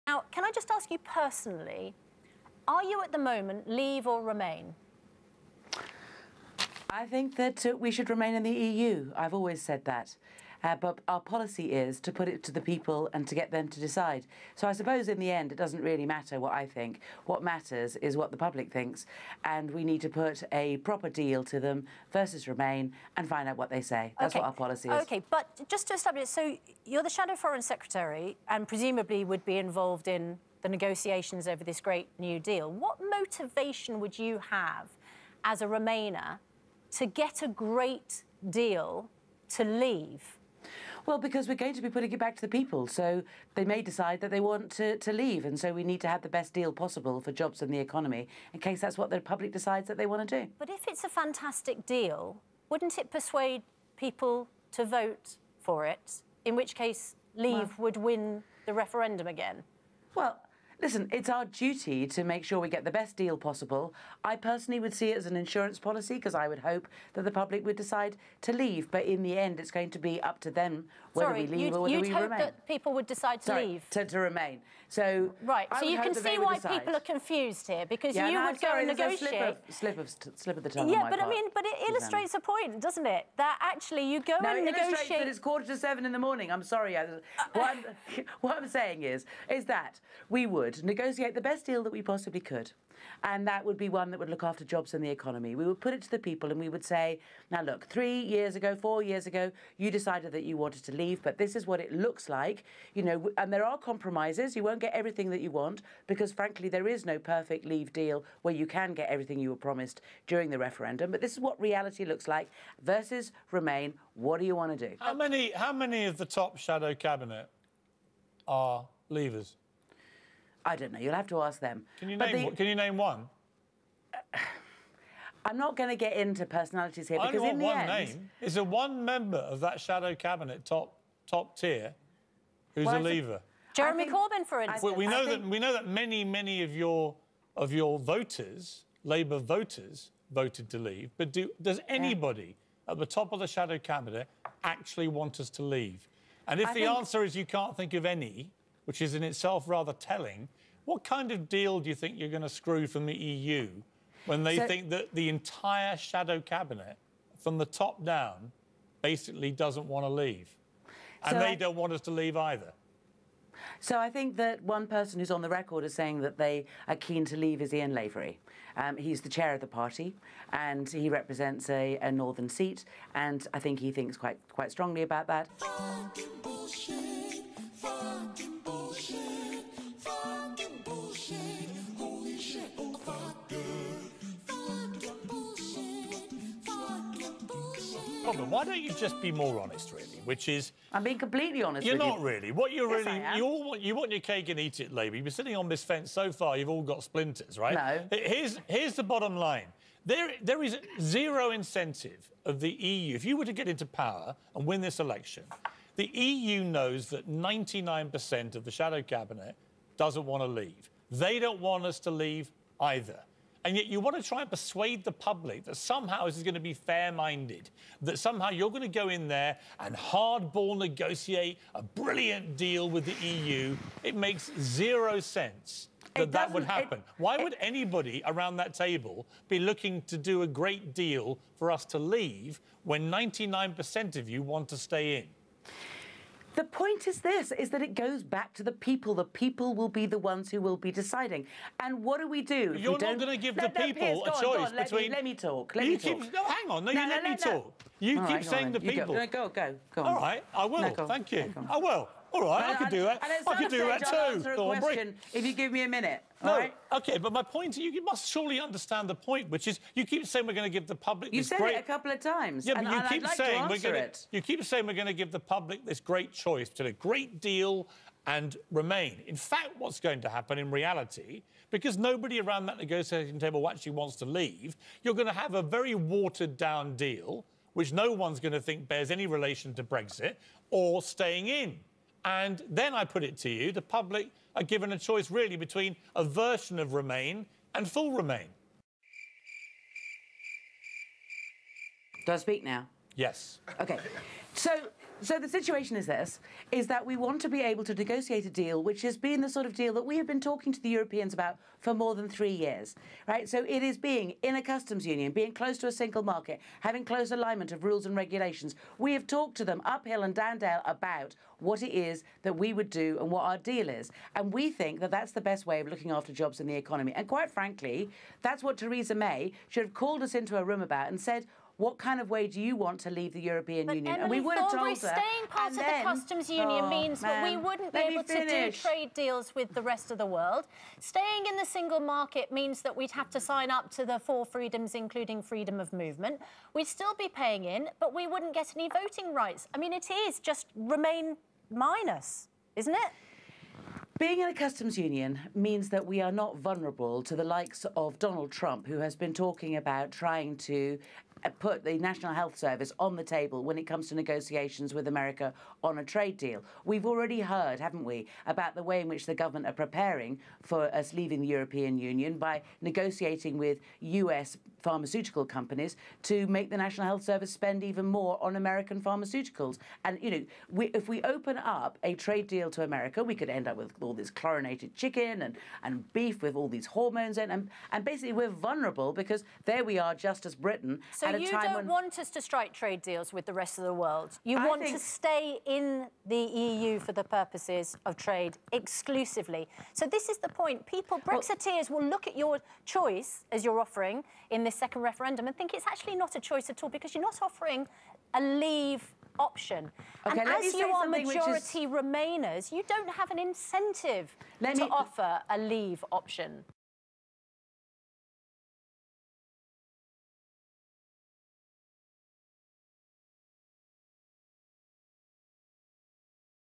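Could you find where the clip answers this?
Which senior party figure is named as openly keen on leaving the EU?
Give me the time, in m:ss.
2:47.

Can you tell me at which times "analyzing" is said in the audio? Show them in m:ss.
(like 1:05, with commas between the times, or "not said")
not said.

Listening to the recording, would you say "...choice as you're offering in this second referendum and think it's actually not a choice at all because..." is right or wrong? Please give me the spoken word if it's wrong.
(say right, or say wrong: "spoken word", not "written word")
right.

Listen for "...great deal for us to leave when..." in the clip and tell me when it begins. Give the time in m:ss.
3:50.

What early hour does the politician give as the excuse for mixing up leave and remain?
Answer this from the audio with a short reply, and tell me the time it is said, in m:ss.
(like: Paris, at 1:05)
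quarter to seven, at 1:25.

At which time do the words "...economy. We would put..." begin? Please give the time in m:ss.
1:35.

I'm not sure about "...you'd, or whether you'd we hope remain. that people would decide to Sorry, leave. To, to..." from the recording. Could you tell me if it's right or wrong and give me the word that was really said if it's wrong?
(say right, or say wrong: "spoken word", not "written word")
right.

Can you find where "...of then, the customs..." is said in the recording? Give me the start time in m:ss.
5:25.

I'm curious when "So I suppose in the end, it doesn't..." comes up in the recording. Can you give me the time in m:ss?
0:14.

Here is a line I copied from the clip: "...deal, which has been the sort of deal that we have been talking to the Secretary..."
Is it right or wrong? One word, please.
wrong.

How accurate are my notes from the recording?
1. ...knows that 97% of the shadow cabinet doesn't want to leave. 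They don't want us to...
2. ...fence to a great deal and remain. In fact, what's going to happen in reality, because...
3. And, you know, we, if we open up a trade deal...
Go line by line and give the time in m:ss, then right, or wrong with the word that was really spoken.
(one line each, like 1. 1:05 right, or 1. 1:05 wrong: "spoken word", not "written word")
1. 3:26 wrong: "99", not "97"
2. 4:26 wrong: "choice", not "fence"
3. 6:10 right.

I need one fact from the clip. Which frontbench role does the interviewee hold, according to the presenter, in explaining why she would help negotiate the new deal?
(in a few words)
Shadow Foreign Secretary.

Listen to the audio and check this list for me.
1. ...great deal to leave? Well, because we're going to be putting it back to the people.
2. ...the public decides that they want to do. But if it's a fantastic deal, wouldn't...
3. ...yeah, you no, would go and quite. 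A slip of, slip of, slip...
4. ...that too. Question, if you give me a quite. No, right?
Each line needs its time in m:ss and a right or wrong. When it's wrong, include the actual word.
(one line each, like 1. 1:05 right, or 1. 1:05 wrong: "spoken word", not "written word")
1. 0:37 right
2. 0:49 right
3. 1:18 wrong: "negotiate", not "quite"
4. 4:13 wrong: "minute", not "quite".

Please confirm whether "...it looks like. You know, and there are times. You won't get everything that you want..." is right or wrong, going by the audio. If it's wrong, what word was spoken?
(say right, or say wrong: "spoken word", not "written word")
wrong: "compromises", not "times".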